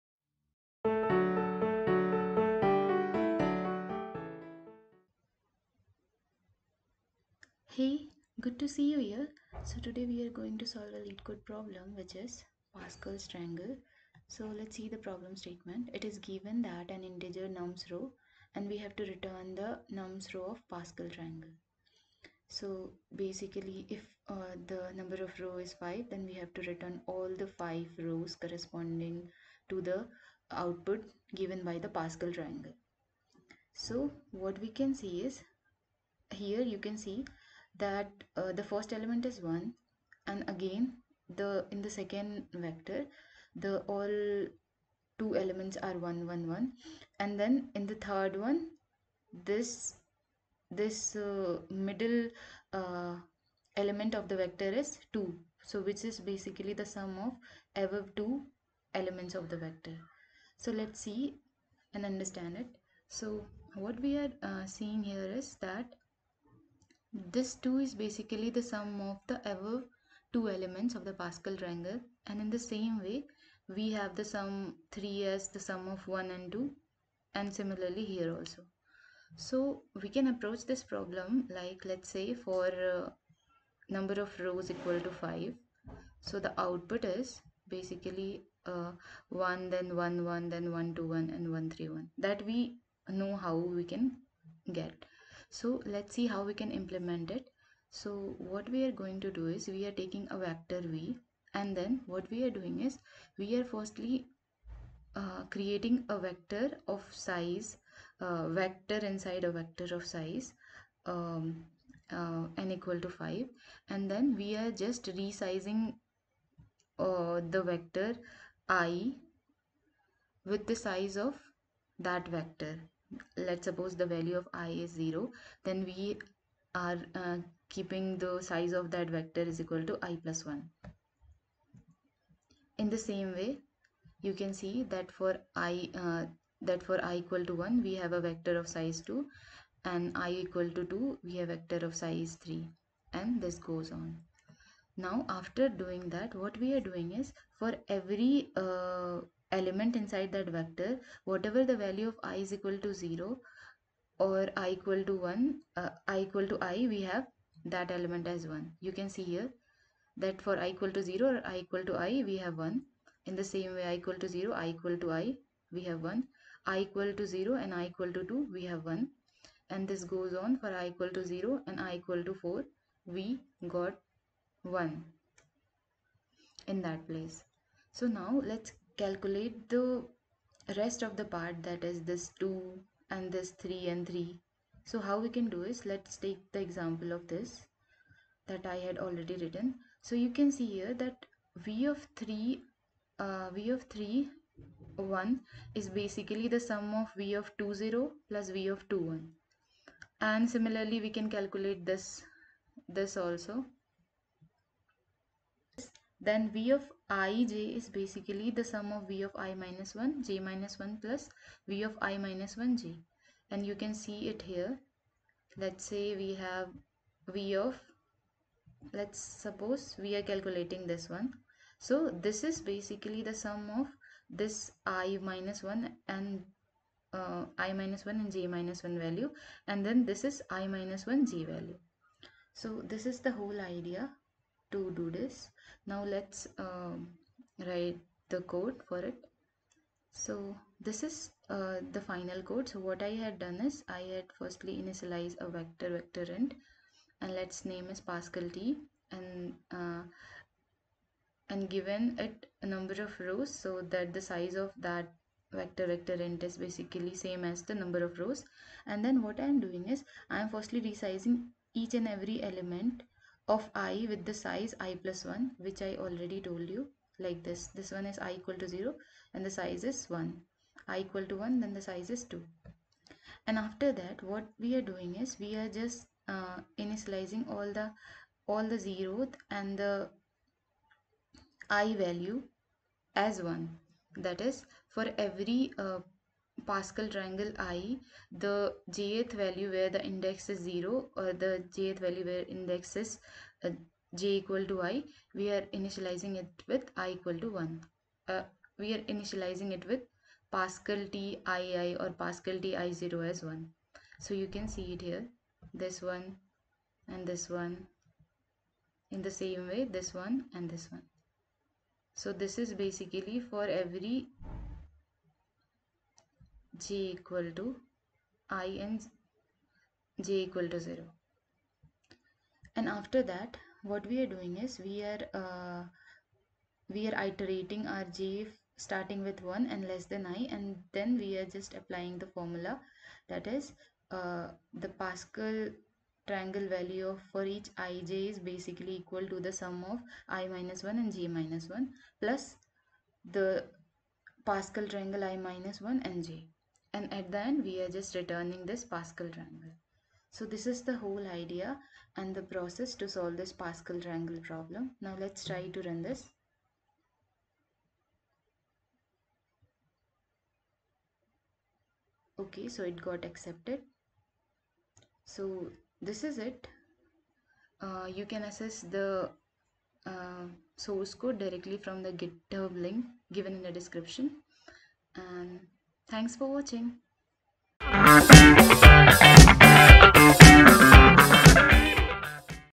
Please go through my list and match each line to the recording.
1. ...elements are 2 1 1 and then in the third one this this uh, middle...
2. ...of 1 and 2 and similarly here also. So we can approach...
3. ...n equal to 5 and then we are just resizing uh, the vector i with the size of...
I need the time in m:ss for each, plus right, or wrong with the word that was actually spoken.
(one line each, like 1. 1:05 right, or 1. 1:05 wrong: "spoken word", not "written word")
1. 0:45 wrong: "1", not "2"
2. 1:15 right
3. 1:52 right.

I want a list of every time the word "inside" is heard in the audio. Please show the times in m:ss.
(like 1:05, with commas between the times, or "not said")
1:48, 2:29.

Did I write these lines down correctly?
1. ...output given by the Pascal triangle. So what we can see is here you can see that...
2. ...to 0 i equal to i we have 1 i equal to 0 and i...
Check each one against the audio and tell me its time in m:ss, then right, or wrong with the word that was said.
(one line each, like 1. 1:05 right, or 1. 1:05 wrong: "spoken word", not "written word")
1. 0:30 right
2. 2:44 right.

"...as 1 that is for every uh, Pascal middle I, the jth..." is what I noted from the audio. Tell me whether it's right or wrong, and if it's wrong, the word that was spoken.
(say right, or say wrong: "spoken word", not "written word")
wrong: "triangle", not "middle".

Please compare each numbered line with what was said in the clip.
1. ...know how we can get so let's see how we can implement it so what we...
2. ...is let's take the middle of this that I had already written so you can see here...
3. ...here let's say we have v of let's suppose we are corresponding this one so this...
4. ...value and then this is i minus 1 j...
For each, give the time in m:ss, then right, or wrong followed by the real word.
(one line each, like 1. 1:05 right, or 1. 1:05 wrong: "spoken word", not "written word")
1. 1:33 right
2. 3:05 wrong: "example", not "middle"
3. 3:34 wrong: "calculating", not "corresponding"
4. 3:49 right.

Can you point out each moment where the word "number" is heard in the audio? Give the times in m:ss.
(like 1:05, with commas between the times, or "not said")
0:24, 1:23, 4:12, 4:17.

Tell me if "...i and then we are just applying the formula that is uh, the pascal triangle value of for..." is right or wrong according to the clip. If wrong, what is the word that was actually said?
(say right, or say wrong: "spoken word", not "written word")
right.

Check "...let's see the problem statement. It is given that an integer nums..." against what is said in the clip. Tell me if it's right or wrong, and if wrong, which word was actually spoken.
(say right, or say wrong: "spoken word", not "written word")
right.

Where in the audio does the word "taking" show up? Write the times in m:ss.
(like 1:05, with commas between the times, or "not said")
1:39.